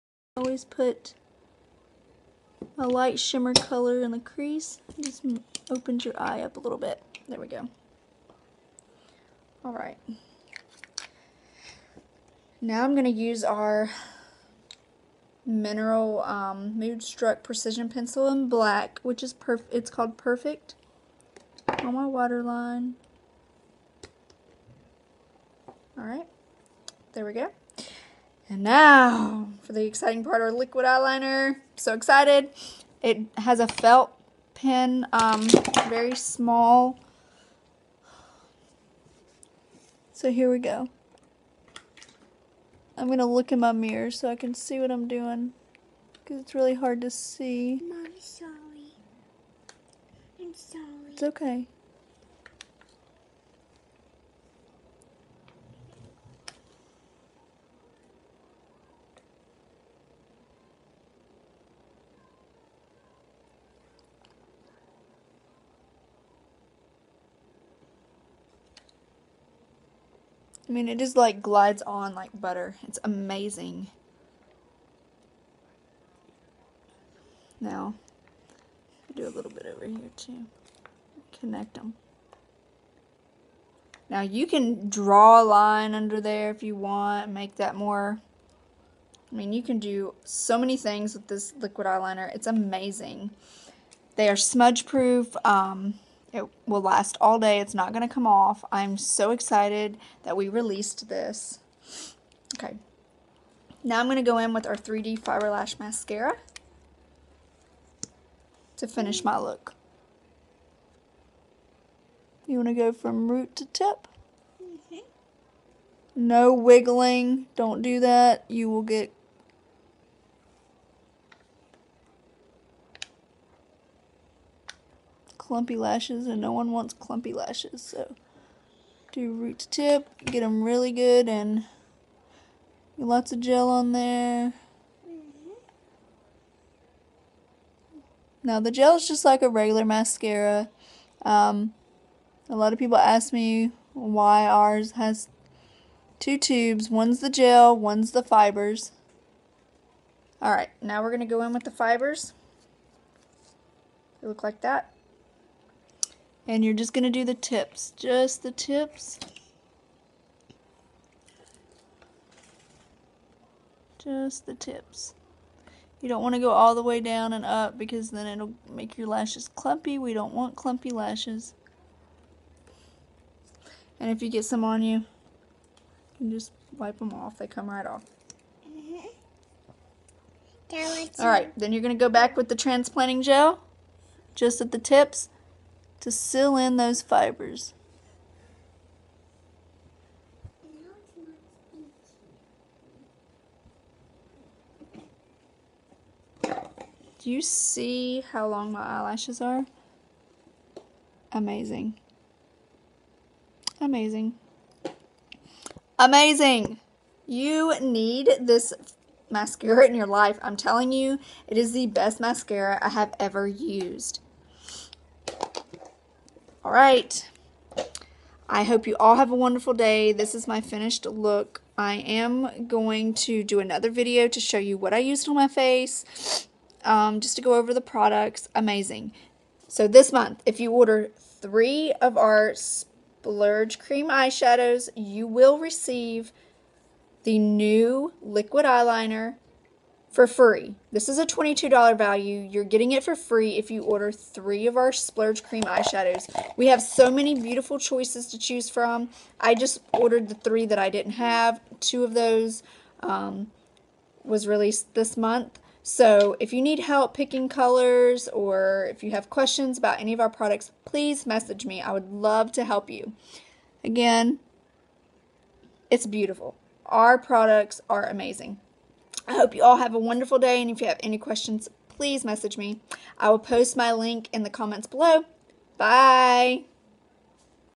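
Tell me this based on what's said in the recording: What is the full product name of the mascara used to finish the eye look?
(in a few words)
3D Fiber Lash Mascara.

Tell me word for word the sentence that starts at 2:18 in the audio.
Now the gel is just like a regular mascara.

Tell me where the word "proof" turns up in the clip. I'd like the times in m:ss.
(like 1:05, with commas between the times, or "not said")
1:34.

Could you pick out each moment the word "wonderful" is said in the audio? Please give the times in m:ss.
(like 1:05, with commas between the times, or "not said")
3:39, 4:29.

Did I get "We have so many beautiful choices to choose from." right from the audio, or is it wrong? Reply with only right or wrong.
right.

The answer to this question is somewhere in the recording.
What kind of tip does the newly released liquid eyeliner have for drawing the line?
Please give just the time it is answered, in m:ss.
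0:33.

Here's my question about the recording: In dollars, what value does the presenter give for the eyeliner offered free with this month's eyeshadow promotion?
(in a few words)
$22.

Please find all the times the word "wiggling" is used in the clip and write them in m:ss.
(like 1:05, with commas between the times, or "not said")
1:56.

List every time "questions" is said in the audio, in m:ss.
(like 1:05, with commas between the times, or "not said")
4:19, 4:31.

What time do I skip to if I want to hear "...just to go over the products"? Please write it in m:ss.
3:47.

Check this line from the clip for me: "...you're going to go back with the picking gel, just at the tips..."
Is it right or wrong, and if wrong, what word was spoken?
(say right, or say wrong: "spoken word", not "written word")
wrong: "transplanting", not "picking".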